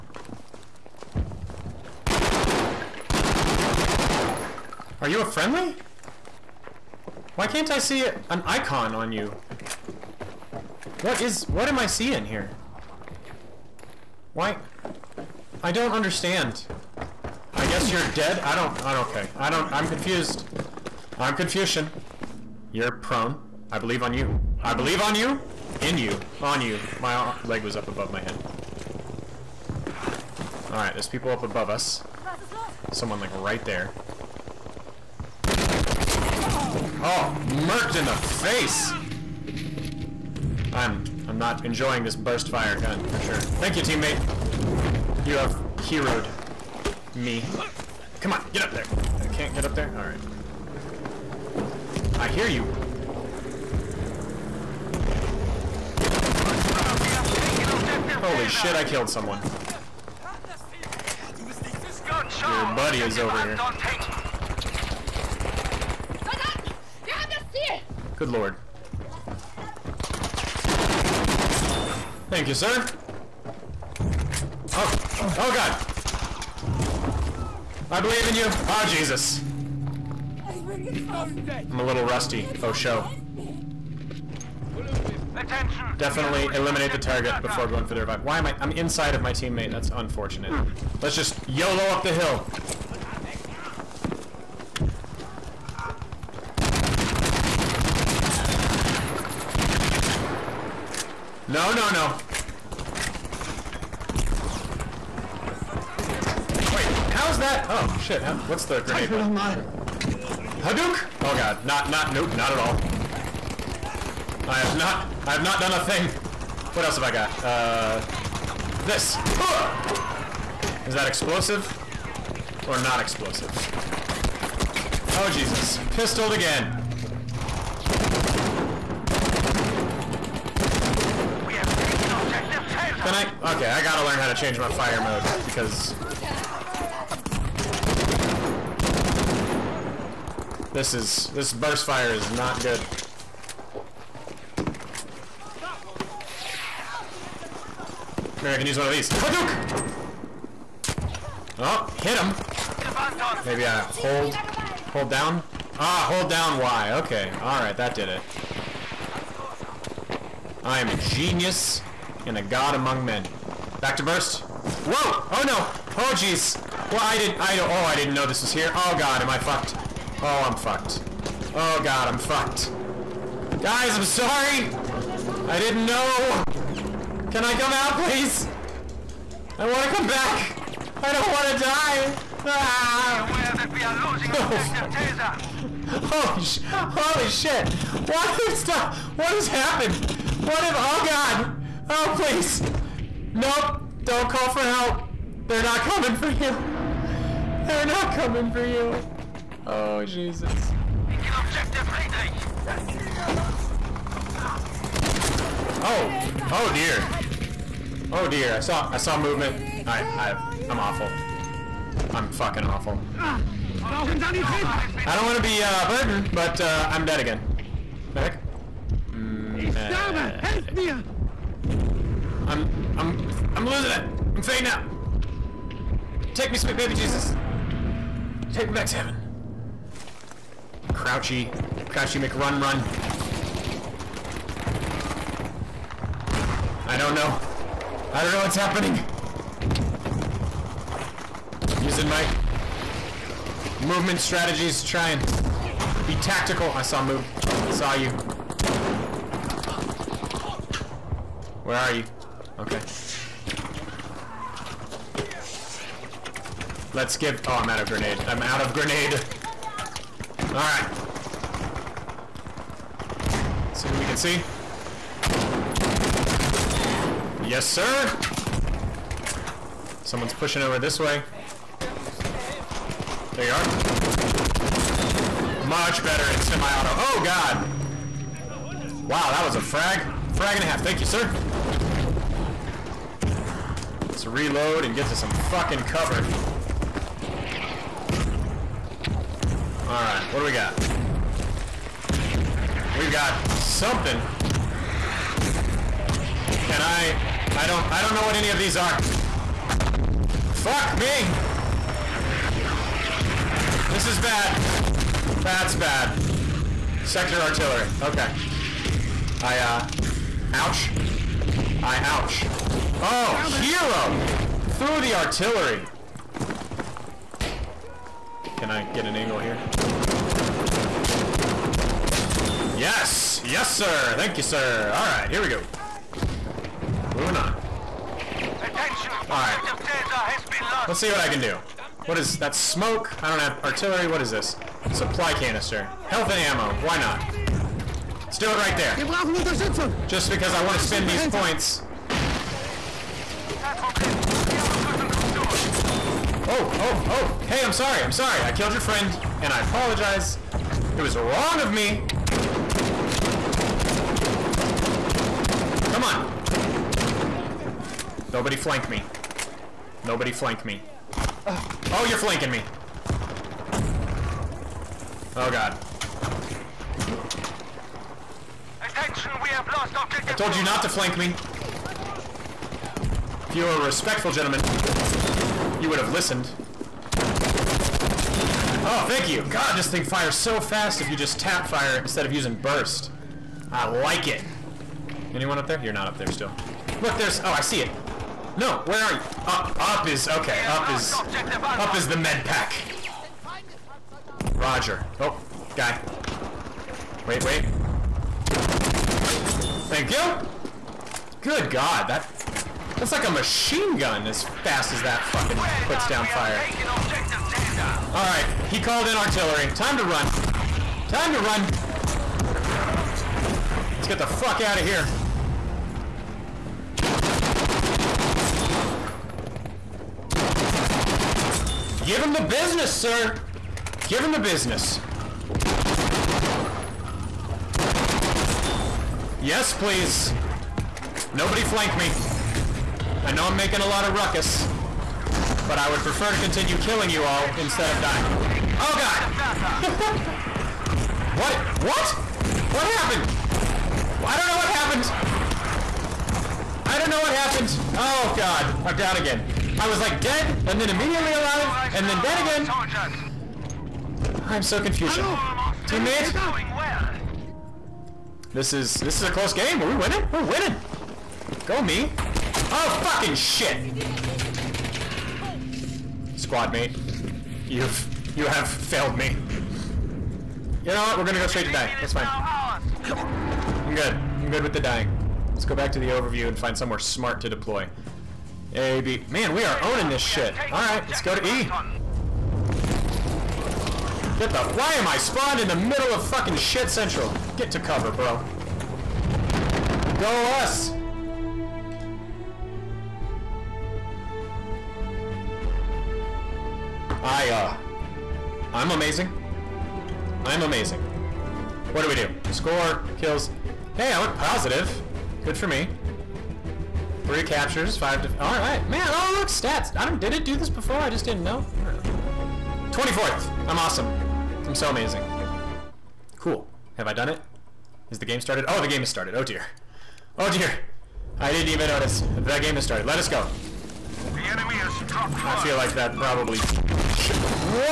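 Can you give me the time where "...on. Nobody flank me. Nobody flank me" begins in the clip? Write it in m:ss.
5:56.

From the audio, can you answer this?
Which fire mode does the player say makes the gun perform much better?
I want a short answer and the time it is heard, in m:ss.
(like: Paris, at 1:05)
Semi-auto, at 4:36.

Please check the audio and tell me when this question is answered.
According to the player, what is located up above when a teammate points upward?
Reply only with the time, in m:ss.
6:32.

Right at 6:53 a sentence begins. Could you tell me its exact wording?
Let's get the fuck out of here.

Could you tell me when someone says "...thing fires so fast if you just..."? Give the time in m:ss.
6:19.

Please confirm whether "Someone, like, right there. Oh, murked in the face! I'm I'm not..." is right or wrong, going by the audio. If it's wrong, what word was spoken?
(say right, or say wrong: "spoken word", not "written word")
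right.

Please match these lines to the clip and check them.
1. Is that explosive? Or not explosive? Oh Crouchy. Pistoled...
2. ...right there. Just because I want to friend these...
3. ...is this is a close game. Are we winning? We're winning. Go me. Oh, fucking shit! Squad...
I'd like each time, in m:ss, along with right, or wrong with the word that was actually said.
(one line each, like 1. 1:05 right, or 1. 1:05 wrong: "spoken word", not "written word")
1. 2:00 wrong: "Jesus", not "Crouchy"
2. 5:38 wrong: "spend", not "friend"
3. 7:38 right.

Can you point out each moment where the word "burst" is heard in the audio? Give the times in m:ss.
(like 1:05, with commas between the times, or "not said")
0:42, 2:21, 2:44, 6:22.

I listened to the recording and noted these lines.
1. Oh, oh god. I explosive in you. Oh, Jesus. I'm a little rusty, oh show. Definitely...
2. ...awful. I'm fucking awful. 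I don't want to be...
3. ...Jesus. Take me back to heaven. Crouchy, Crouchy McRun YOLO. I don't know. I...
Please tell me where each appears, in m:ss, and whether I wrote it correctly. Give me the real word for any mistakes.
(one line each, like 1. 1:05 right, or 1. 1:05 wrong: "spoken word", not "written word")
1. 1:14 wrong: "believe", not "explosive"
2. 3:30 right
3. 3:46 wrong: "Run", not "YOLO".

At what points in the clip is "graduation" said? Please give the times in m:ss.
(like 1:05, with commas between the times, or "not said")
not said.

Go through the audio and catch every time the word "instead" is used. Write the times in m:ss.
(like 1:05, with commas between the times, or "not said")
6:21, 7:17.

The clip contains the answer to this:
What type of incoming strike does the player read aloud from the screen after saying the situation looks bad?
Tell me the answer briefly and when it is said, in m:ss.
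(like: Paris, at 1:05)
Sector artillery, at 5:07.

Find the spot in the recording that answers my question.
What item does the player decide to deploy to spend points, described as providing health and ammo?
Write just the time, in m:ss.
5:34.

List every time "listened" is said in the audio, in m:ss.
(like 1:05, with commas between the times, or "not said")
6:16.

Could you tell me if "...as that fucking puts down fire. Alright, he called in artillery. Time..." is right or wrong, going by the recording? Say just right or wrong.
right.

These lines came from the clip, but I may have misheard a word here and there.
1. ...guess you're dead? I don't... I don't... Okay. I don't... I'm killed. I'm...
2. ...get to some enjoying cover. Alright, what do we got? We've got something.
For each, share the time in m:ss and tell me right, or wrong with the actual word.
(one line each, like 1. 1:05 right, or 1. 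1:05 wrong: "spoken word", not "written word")
1. 0:17 wrong: "confused", not "killed"
2. 4:44 wrong: "fucking", not "enjoying".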